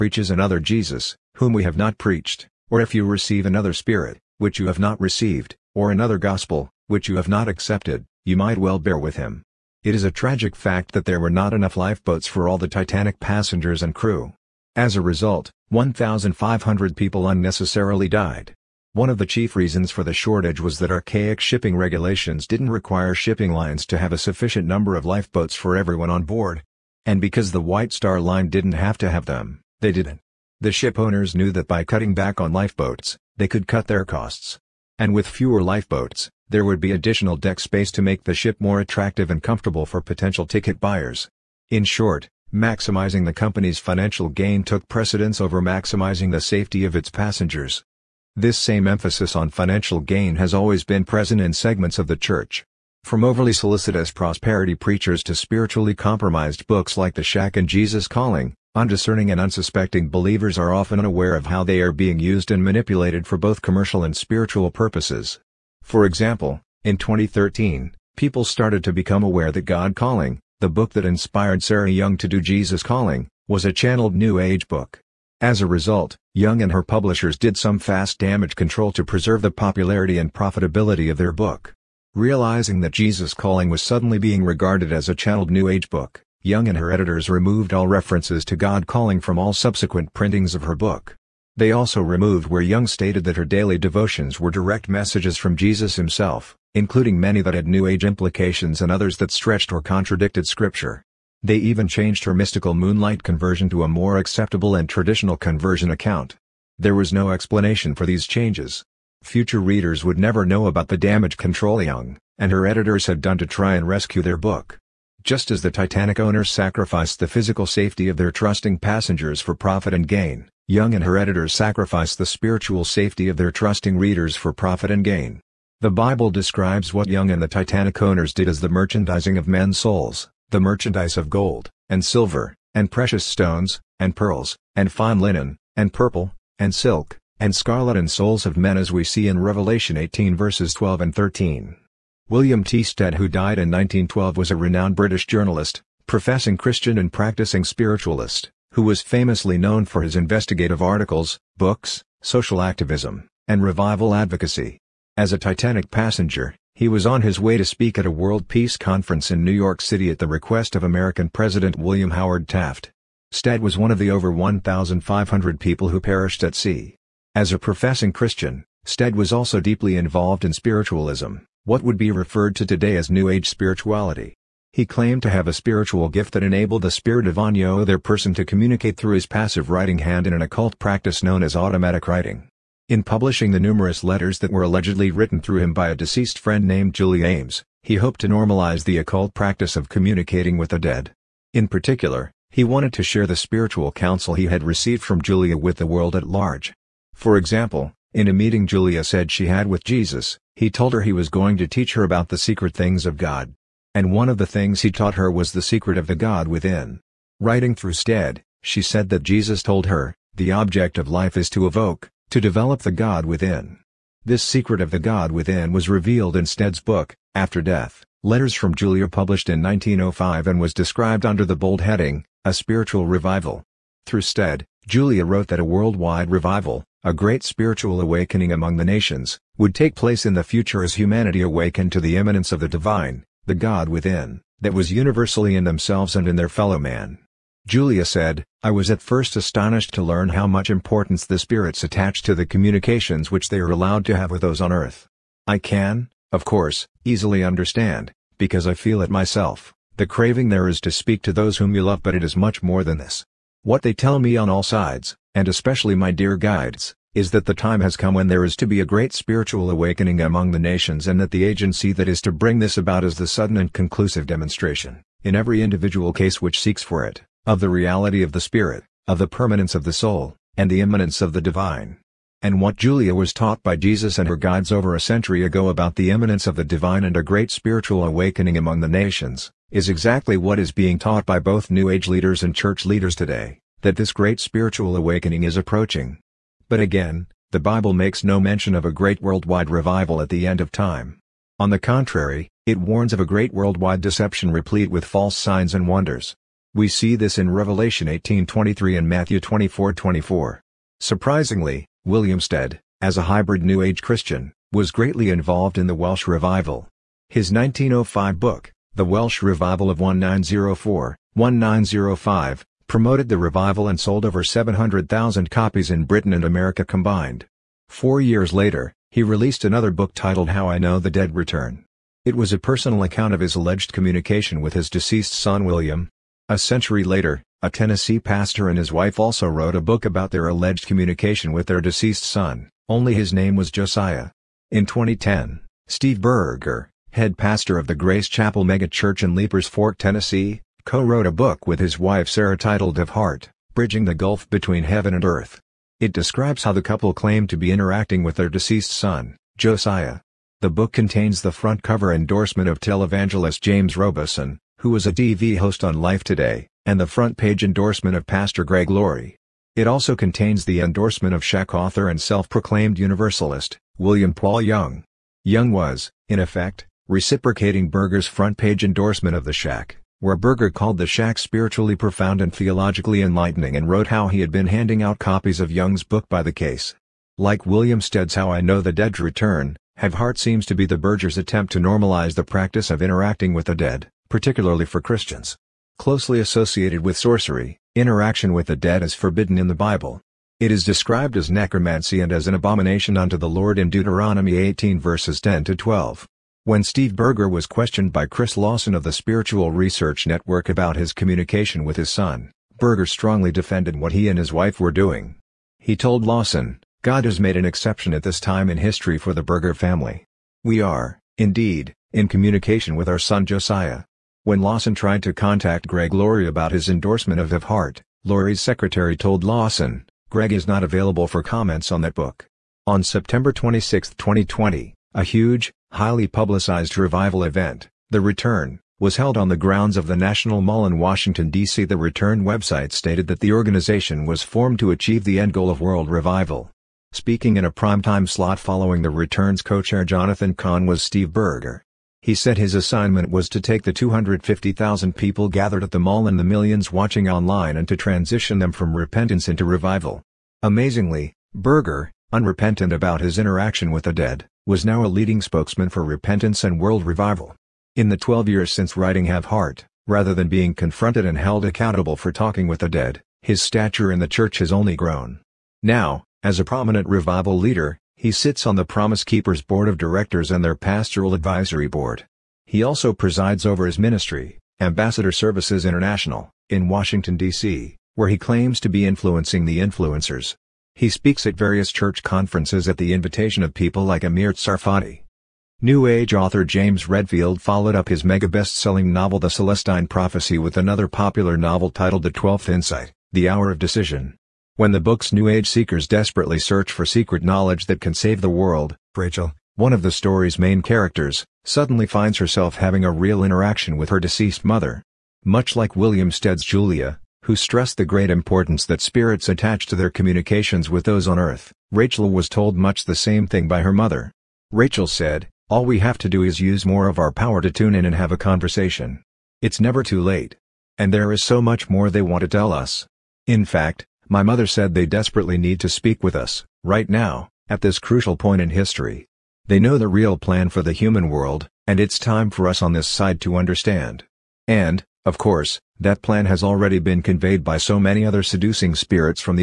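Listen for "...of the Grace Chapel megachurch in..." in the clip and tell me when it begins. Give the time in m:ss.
5:37.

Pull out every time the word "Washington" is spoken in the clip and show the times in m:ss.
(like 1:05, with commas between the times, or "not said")
7:10, 7:56.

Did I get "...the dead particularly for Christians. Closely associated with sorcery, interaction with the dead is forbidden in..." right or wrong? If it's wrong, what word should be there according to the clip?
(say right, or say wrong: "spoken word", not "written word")
right.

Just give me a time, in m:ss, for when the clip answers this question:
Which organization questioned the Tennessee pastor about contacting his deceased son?
6:39.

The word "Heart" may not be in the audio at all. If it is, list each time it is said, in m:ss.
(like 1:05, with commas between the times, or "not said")
5:43, 6:20, 6:57, 7:39.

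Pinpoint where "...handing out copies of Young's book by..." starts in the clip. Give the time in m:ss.
6:14.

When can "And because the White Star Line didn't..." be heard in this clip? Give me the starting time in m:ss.
0:27.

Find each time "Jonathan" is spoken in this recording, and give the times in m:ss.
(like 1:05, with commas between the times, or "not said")
7:20.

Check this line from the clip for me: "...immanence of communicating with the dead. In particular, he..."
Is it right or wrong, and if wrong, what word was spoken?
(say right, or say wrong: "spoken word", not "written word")
wrong: "practice", not "immanence".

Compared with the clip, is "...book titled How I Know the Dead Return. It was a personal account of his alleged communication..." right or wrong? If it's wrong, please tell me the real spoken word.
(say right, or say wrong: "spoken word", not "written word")
right.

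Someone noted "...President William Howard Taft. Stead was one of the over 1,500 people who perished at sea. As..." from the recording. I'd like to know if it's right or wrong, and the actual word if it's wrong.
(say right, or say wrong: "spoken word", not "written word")
right.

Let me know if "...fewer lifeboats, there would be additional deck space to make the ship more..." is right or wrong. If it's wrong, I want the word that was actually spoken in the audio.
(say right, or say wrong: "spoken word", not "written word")
right.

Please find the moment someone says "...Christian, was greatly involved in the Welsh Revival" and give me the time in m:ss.
5:03.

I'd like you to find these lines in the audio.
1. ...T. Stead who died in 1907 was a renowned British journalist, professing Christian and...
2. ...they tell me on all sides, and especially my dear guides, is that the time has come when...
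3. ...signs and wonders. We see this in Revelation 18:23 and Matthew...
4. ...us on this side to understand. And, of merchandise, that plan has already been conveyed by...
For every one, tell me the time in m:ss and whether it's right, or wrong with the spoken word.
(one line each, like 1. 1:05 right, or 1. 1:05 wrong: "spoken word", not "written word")
1. 2:22 wrong: "1912", not "1907"
2. 4:13 right
3. 4:55 right
4. 8:52 wrong: "course", not "merchandise".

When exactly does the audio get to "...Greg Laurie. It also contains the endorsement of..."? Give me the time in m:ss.
5:58.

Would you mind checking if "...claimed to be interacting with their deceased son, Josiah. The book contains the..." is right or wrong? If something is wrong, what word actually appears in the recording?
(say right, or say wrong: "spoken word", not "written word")
right.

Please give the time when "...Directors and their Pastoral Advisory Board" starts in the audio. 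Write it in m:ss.
7:49.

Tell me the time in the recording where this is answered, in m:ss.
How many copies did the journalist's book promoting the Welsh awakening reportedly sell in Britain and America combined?
5:14.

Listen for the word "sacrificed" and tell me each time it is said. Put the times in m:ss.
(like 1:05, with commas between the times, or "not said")
1:56, 2:01.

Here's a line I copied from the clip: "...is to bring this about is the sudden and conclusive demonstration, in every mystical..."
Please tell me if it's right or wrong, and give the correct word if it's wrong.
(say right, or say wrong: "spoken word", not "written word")
wrong: "individual", not "mystical".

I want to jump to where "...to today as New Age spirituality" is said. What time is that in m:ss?
2:52.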